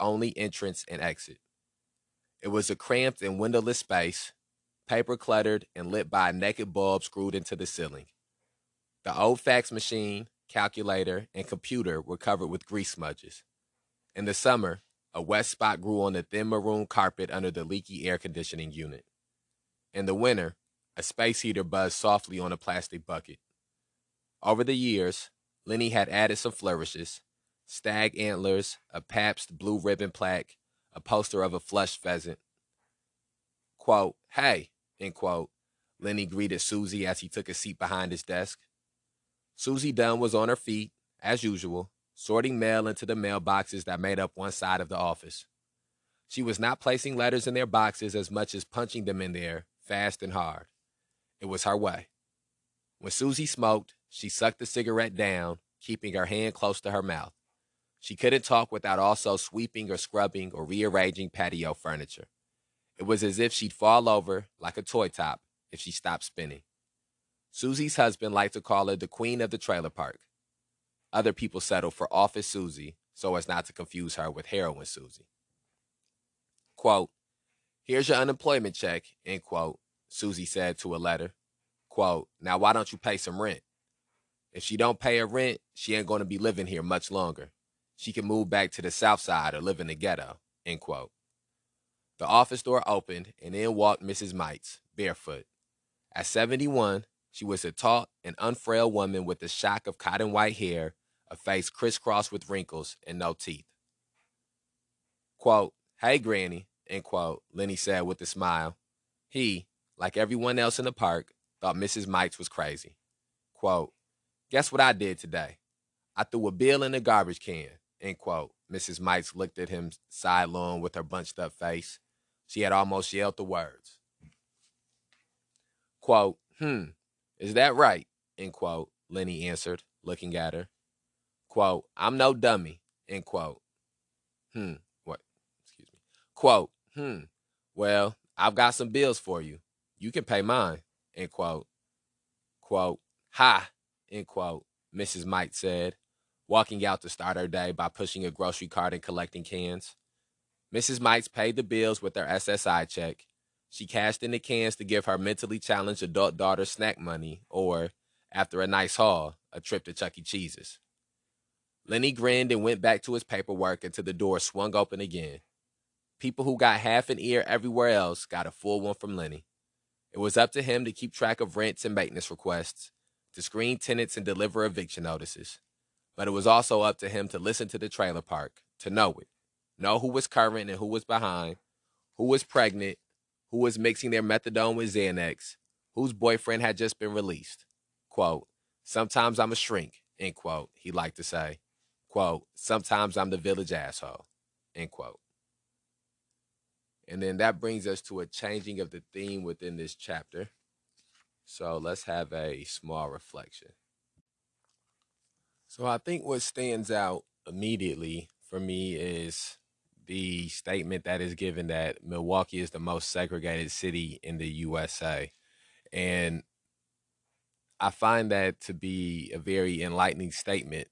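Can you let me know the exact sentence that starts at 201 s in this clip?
So let's have a small reflection.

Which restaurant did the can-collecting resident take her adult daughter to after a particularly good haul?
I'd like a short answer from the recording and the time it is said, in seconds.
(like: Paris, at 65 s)
Chuck E. Cheese's, at 159 s.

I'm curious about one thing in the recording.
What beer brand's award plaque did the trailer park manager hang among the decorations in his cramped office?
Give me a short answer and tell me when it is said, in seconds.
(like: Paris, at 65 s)
Pabst Blue Ribbon, at 29 s.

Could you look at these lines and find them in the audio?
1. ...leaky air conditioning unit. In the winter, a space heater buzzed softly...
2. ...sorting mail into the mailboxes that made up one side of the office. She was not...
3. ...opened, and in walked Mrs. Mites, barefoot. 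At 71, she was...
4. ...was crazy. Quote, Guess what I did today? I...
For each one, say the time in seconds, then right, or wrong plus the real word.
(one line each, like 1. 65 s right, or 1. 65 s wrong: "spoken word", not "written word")
1. 17 s right
2. 42 s right
3. 92 s right
4. 112 s right.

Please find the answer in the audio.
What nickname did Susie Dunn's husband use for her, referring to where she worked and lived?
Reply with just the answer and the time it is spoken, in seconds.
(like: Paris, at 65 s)
Queen of the trailer park, at 69 s.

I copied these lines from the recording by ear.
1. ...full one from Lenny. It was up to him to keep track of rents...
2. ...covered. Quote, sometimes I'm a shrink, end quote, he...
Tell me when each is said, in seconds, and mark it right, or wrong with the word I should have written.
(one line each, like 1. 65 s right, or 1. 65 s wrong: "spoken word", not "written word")
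1. 168 s right
2. 187 s wrong: "released", not "covered".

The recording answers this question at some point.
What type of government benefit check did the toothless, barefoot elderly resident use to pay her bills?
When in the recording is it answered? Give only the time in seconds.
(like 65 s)
152 s.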